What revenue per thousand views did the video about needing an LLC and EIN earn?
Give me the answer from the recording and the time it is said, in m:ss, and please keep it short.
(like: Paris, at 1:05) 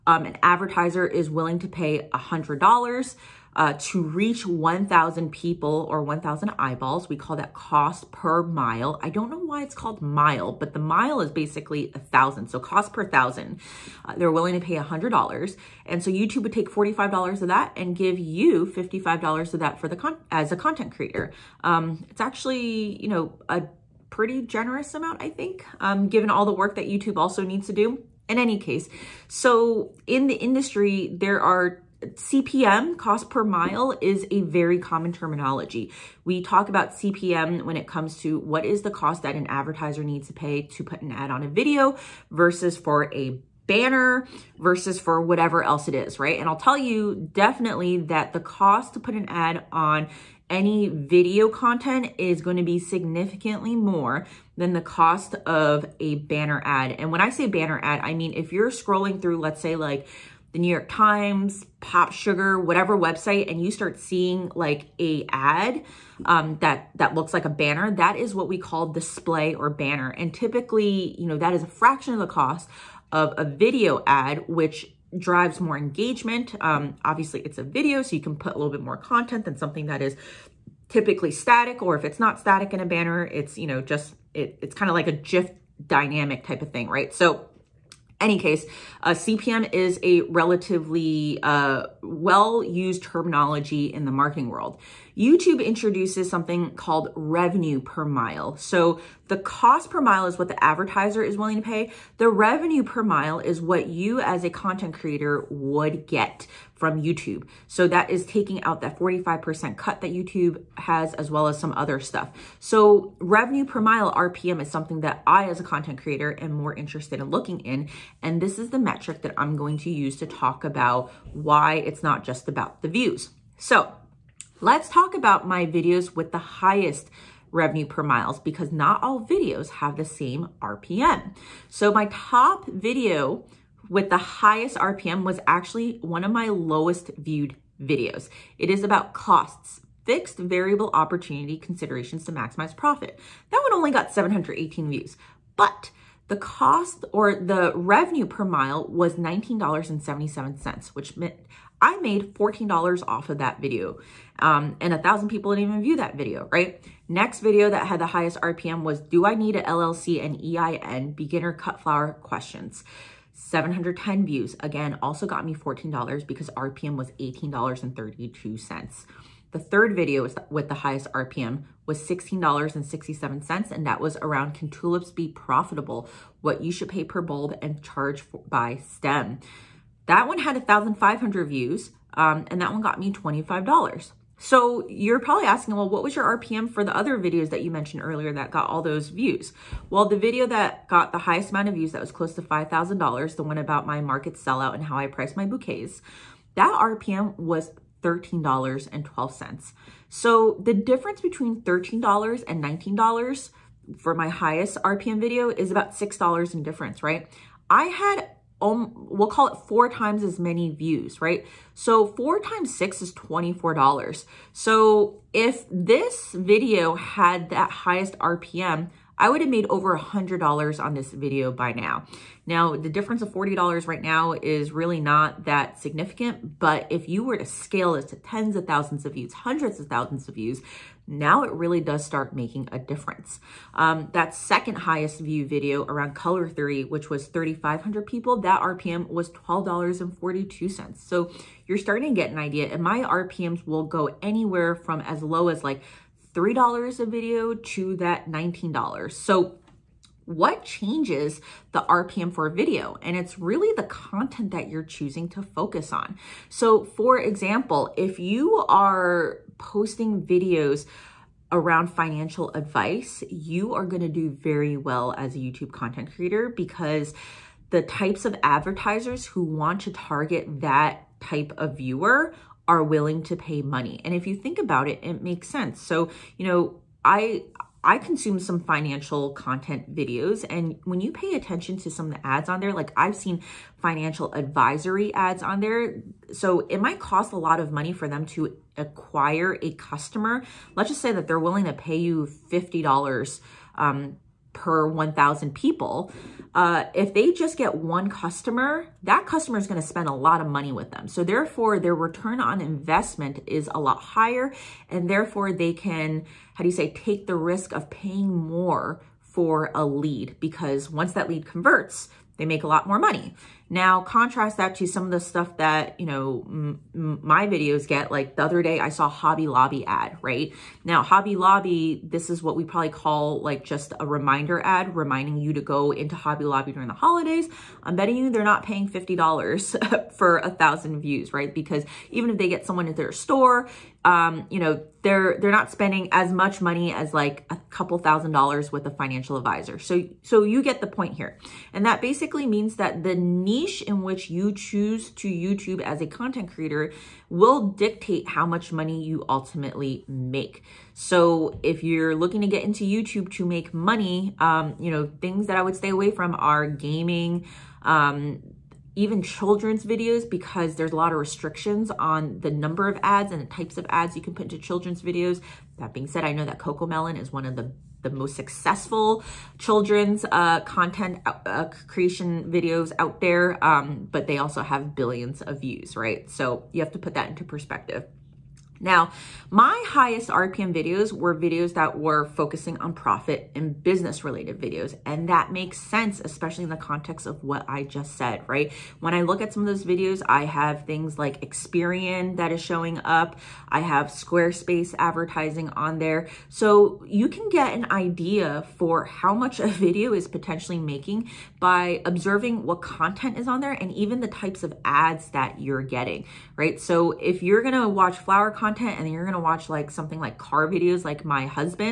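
$18.32, at 2:47.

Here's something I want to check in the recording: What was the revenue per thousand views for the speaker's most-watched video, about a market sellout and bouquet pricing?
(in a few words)
$13.12.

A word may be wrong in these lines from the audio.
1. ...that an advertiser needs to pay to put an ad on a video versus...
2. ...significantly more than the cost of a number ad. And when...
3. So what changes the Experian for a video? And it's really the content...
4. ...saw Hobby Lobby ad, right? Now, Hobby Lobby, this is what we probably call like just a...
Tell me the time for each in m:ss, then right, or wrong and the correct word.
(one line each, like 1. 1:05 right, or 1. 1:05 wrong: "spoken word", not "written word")
1. 0:39 right
2. 0:52 wrong: "banner", not "number"
3. 4:09 wrong: "RPM", not "Experian"
4. 5:18 right.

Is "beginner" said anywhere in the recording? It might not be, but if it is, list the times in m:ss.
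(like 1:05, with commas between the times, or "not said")
2:41.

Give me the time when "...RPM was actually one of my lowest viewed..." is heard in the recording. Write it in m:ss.
2:14.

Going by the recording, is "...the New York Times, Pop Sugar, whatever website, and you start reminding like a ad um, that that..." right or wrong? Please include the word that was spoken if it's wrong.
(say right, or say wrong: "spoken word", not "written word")
wrong: "seeing", not "reminding".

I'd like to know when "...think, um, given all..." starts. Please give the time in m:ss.
0:25.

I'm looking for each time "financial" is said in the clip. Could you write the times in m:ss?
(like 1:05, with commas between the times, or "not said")
4:21, 4:38, 4:43, 5:38.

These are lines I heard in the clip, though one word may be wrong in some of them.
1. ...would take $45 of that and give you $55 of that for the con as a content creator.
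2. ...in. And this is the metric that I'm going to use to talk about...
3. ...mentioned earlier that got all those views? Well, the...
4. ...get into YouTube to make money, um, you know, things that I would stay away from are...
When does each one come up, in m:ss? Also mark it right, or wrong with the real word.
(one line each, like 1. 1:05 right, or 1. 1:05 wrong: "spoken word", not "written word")
1. 0:16 right
2. 1:57 right
3. 3:07 right
4. 5:52 right.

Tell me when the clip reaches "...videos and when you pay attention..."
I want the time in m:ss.
4:39.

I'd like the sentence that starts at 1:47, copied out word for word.
So that is taking out that 45% cut that YouTube has as well as some other stuff.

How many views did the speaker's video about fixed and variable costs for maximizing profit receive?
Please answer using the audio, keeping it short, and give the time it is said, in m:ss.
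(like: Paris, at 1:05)
718, at 2:24.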